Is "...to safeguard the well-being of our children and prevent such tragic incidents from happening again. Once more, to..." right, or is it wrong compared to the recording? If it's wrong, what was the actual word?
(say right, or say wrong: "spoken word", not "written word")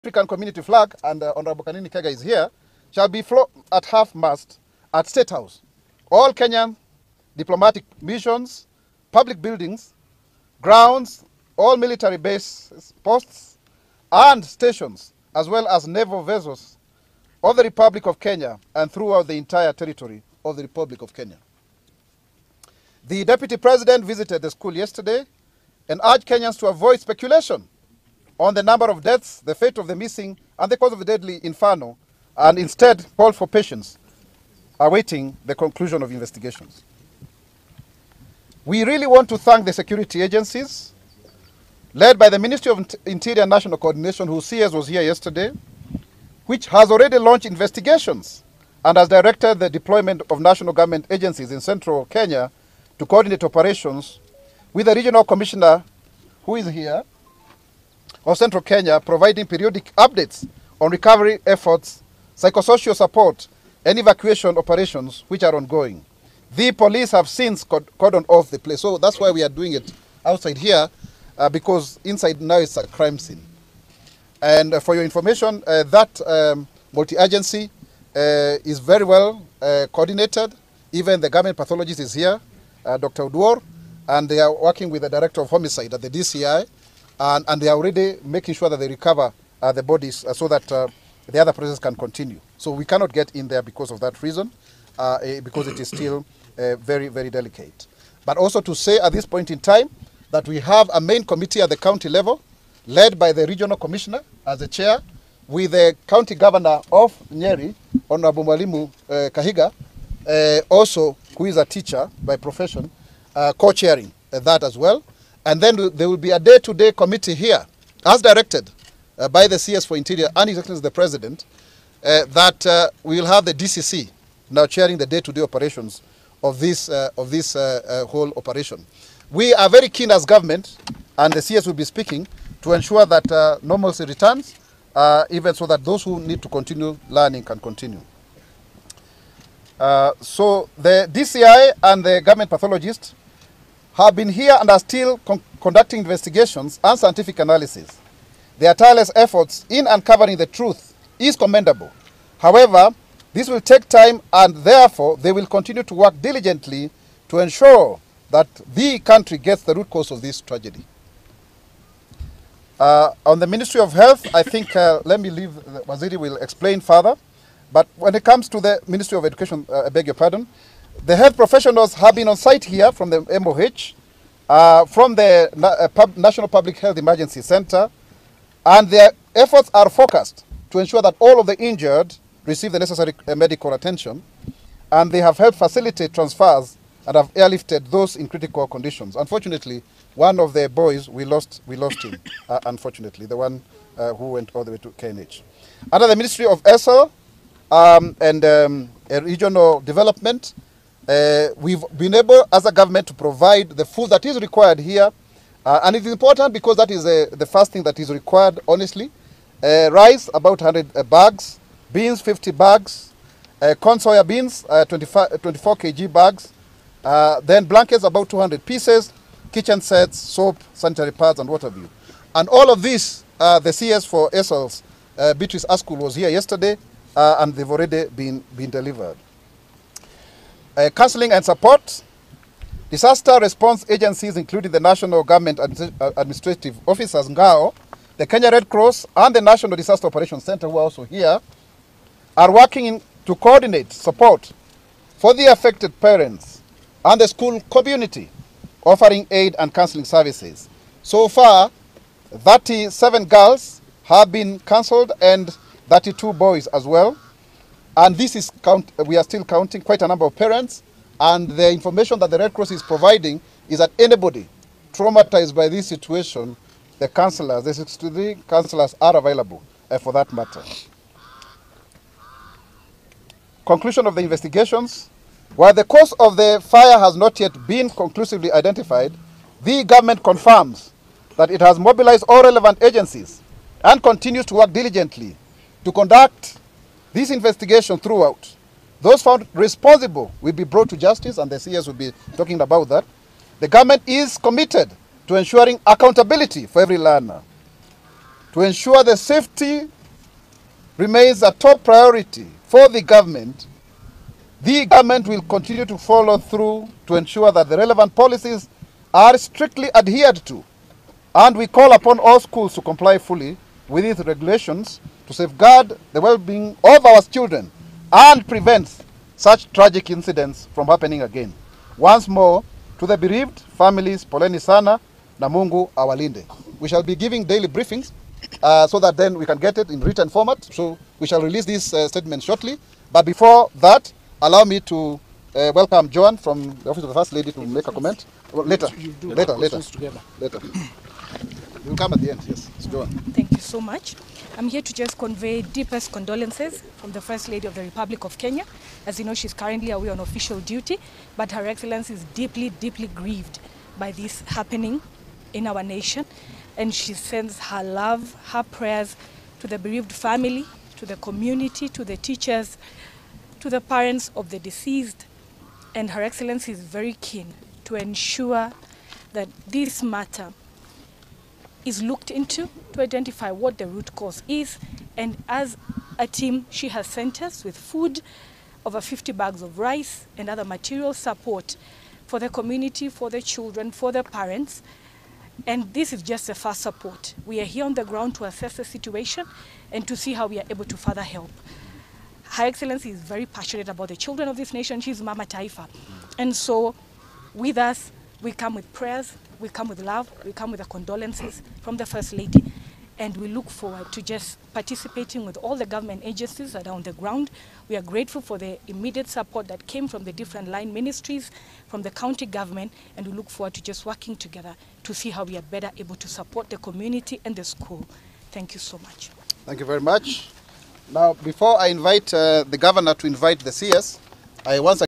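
right.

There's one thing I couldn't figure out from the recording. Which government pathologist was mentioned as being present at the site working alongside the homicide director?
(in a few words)
Dr. Oduor.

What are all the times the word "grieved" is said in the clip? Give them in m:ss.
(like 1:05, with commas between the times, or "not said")
5:53.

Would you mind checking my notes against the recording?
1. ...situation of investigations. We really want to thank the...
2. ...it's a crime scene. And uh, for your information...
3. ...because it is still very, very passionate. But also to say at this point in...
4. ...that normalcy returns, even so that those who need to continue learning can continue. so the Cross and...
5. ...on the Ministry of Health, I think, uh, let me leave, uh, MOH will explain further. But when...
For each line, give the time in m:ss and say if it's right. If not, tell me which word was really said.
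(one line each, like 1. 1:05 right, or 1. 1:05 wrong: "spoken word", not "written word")
1. 0:35 wrong: "conclusion", not "situation"
2. 1:12 right
3. 1:35 wrong: "delicate", not "passionate"
4. 2:13 wrong: "DCI", not "Cross"
5. 2:43 wrong: "Waziri", not "MOH".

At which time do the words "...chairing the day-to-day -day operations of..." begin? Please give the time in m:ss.
2:04.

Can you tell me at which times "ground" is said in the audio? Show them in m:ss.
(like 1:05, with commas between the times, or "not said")
0:10, 6:28, 6:47.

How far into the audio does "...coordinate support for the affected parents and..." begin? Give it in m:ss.
4:03.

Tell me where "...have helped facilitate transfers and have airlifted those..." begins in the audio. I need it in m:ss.
3:05.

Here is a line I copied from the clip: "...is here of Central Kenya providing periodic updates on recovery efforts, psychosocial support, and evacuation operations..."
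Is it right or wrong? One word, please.
right.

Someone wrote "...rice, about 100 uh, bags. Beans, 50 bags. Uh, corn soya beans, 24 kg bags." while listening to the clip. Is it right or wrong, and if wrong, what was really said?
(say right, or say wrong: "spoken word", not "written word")
right.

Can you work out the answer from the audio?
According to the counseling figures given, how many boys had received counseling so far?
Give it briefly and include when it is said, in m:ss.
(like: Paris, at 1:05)
32, at 4:15.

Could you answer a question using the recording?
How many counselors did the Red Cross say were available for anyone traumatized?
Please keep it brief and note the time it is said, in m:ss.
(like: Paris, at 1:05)
63, at 4:27.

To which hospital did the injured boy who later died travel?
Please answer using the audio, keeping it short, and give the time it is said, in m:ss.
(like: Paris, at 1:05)
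KNH, at 3:14.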